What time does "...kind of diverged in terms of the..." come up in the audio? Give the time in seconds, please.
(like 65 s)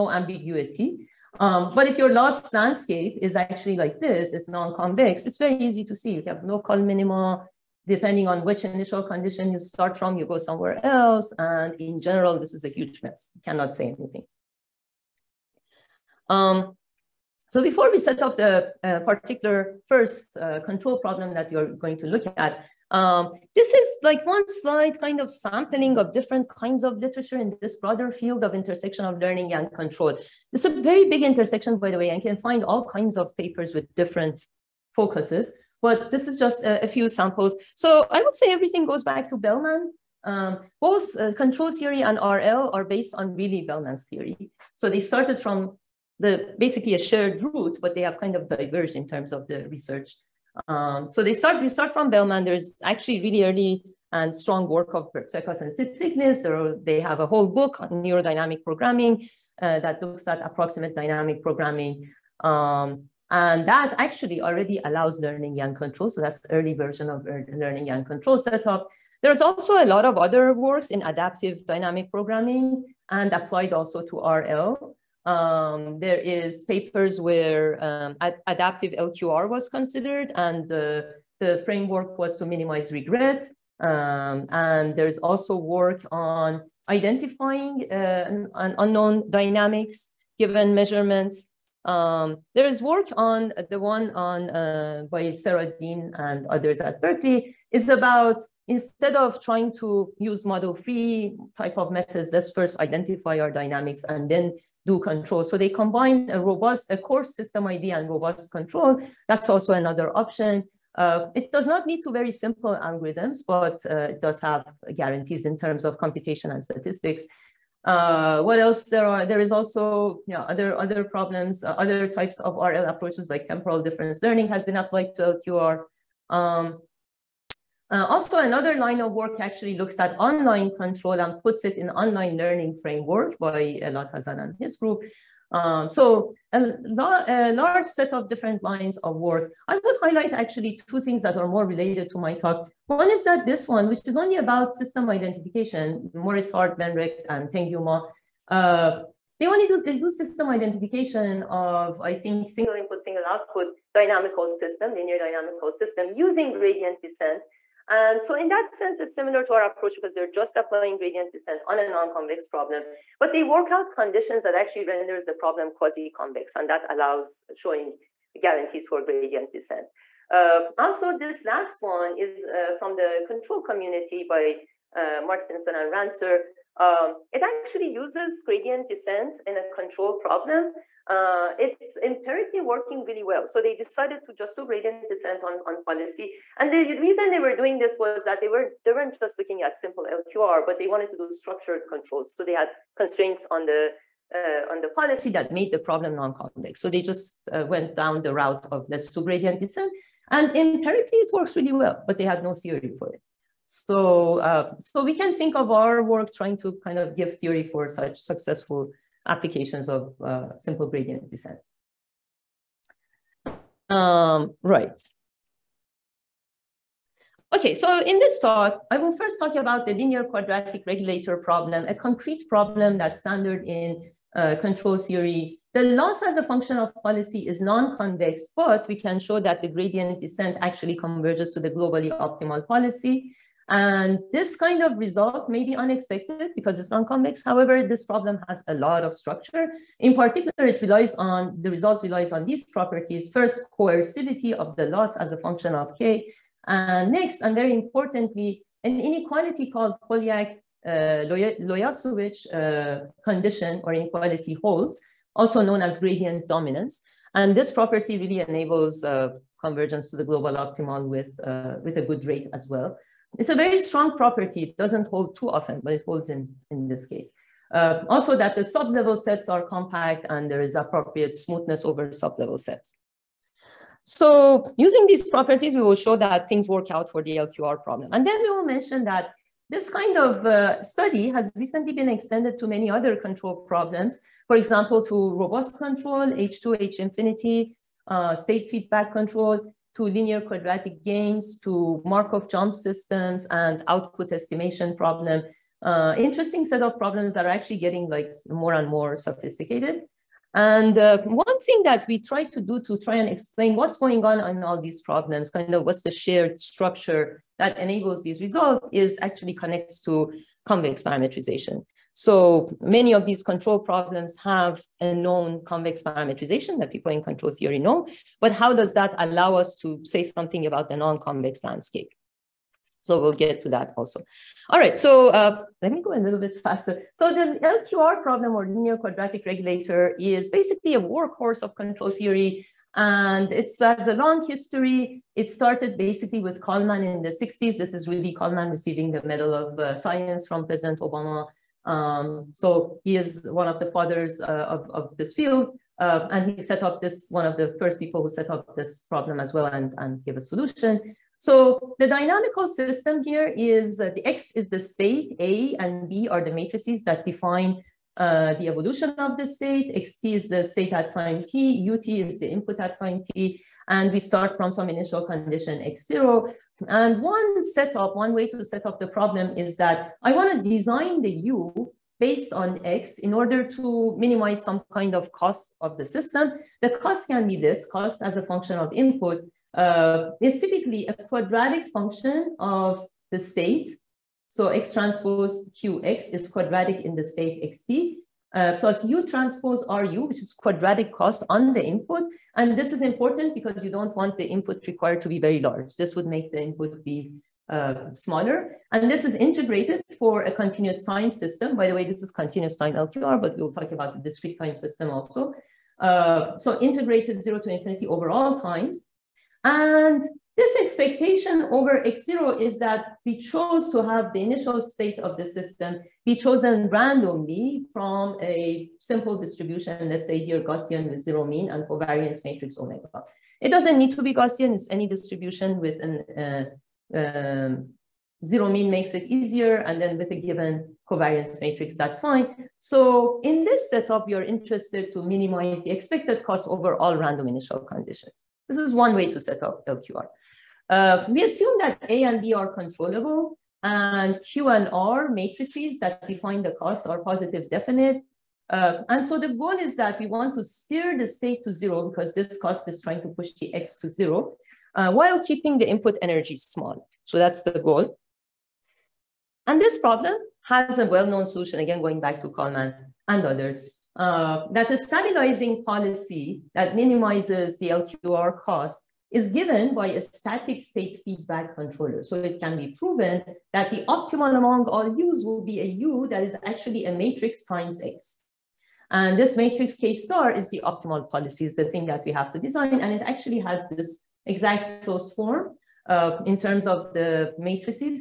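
48 s.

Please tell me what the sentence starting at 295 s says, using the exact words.
Uh, interesting set of problems that are actually getting like more and more sophisticated.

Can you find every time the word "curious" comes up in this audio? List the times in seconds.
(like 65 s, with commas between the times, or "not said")
not said.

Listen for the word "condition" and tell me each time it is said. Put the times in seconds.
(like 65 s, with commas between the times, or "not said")
9 s, 163 s, 253 s, 365 s, 437 s.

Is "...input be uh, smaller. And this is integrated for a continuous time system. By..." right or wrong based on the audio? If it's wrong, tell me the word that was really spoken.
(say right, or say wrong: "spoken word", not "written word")
right.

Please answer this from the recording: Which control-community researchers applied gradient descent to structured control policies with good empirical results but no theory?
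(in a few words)
Mårtensson and Rantzer.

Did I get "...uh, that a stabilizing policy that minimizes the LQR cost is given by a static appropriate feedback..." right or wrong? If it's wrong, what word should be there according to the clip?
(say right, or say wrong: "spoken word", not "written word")
wrong: "state", not "appropriate".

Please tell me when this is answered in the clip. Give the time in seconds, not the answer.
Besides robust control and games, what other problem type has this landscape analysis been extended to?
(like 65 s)
292 s.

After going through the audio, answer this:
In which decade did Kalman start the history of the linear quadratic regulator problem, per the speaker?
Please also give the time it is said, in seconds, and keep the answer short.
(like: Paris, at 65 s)
the 60s, at 337 s.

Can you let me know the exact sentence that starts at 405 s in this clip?
Uh, so integrated zero to infinity overall times.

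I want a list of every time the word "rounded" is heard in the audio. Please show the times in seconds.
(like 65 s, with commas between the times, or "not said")
not said.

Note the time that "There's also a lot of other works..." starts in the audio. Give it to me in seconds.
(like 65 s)
69 s.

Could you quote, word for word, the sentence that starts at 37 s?
So I would say everything goes back to Bellman.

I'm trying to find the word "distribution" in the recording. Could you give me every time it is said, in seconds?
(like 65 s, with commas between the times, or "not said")
419 s, 425 s.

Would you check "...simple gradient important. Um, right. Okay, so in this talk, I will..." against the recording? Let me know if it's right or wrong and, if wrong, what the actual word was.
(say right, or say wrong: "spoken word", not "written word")
wrong: "descent", not "important".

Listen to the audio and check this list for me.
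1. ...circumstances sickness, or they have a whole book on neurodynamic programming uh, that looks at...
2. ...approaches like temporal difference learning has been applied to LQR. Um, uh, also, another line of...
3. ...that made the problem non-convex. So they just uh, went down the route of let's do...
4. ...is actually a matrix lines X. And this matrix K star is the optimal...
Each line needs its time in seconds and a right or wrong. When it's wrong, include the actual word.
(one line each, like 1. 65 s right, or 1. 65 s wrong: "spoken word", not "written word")
1. 55 s right
2. 122 s right
3. 195 s right
4. 476 s wrong: "times", not "lines".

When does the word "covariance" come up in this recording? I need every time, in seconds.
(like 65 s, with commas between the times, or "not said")
421 s, 431 s.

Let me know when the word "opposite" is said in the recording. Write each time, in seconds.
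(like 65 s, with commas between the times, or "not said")
not said.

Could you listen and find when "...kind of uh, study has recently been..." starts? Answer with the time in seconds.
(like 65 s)
279 s.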